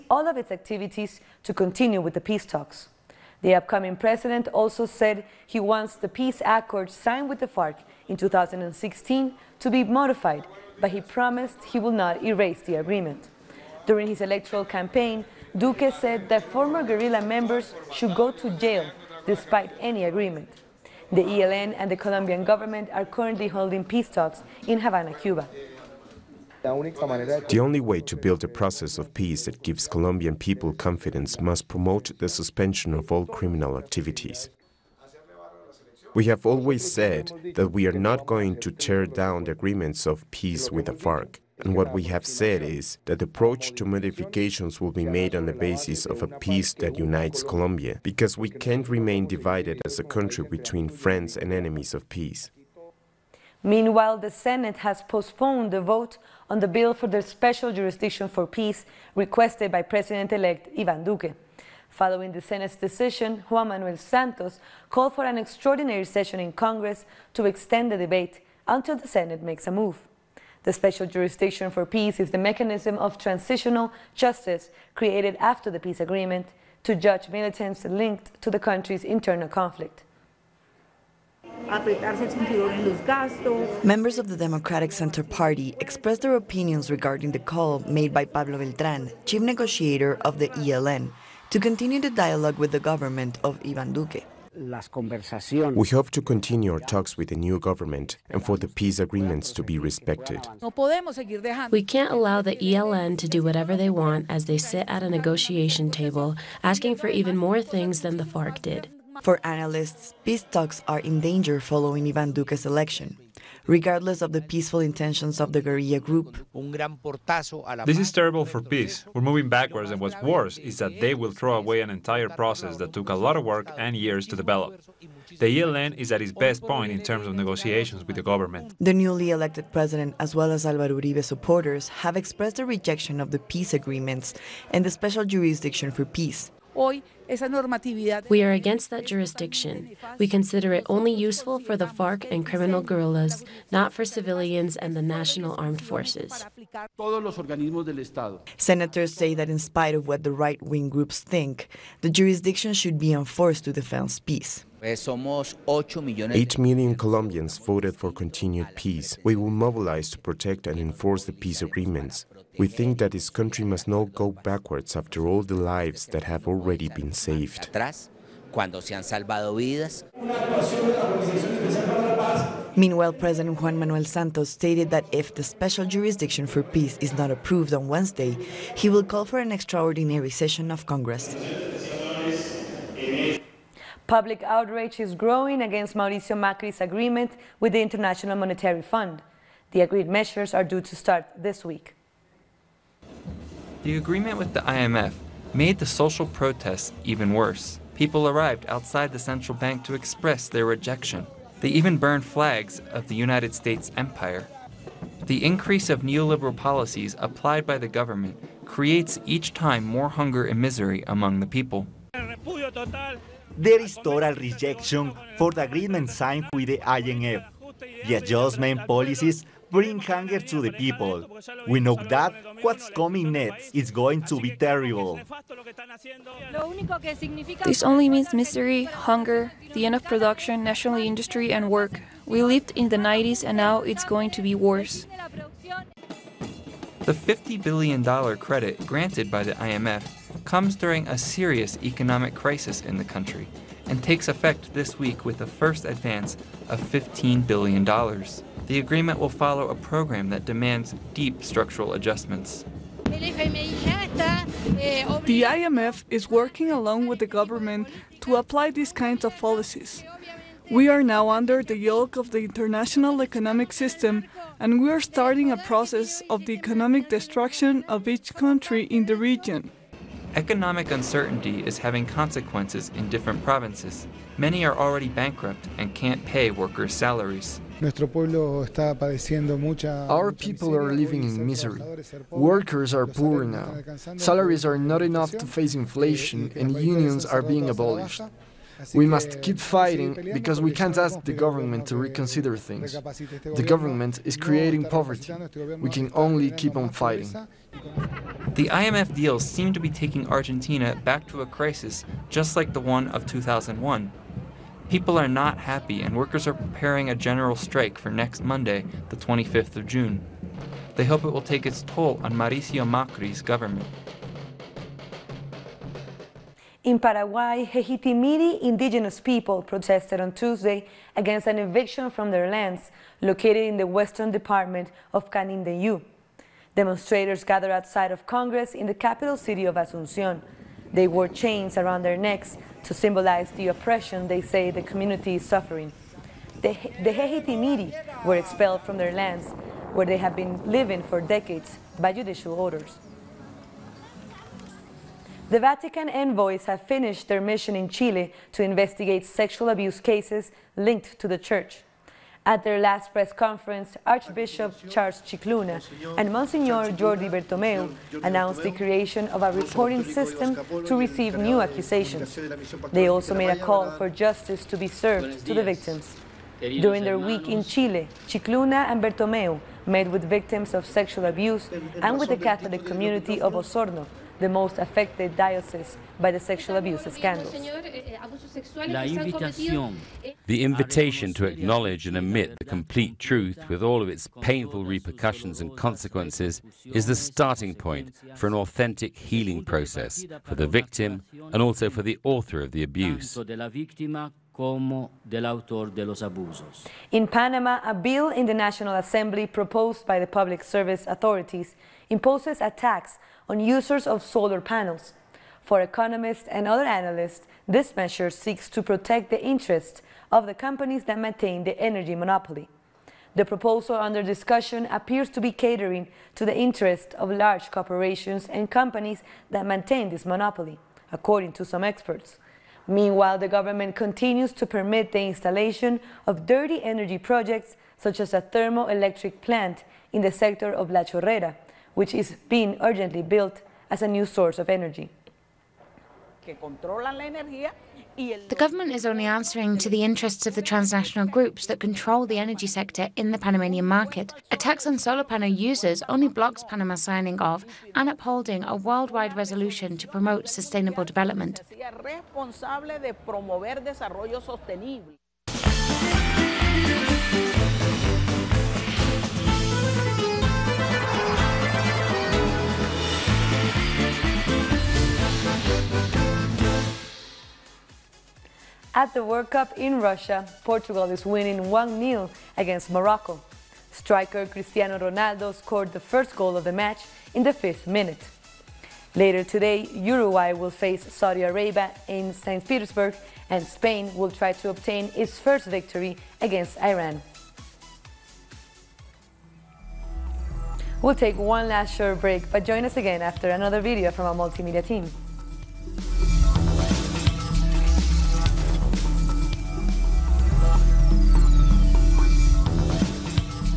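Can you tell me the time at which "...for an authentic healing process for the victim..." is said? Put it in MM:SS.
06:28.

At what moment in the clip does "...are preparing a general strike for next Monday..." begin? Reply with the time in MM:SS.
05:06.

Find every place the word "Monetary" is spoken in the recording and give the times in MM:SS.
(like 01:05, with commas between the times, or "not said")
03:08.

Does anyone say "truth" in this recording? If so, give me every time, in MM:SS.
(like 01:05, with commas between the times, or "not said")
06:23.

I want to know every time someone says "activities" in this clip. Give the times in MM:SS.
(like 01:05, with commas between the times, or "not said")
00:00, 00:33.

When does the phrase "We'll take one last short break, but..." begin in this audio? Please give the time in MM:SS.
08:10.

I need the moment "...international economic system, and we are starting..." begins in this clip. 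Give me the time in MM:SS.
04:22.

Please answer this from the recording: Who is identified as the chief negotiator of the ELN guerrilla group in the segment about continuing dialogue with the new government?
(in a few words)
Pablo Beltran.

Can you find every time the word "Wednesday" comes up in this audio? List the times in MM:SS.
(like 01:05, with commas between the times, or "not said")
02:57.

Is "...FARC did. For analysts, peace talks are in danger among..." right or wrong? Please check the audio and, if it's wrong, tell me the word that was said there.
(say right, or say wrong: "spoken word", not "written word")
wrong: "following", not "among".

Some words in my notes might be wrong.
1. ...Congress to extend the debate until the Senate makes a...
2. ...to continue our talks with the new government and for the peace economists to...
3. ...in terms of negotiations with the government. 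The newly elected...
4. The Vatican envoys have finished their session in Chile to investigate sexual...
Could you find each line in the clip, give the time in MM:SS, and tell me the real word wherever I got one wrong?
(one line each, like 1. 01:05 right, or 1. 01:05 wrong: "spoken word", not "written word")
1. 01:06 right
2. 01:36 wrong: "agreements", not "economists"
3. 02:06 right
4. 05:45 wrong: "mission", not "session".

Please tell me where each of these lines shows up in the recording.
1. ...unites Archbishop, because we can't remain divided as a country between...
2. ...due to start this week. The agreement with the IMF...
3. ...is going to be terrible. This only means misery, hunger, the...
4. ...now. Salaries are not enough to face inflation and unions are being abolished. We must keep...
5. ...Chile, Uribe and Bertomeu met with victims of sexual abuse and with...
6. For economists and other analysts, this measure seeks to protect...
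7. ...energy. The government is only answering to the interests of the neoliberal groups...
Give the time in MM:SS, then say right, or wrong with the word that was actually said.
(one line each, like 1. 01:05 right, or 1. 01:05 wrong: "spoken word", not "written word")
1. 00:46 wrong: "Colombia", not "Archbishop"
2. 03:10 right
3. 03:43 right
4. 04:43 right
5. 06:07 wrong: "Scicluna", not "Uribe"
6. 06:45 right
7. 07:14 wrong: "transnational", not "neoliberal".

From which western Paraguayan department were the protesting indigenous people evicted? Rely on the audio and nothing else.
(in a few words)
Canindeyú.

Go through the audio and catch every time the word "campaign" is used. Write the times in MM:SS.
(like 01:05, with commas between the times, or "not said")
00:14.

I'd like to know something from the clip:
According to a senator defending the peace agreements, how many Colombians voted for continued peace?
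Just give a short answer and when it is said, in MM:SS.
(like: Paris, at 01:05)
8 million, at 02:34.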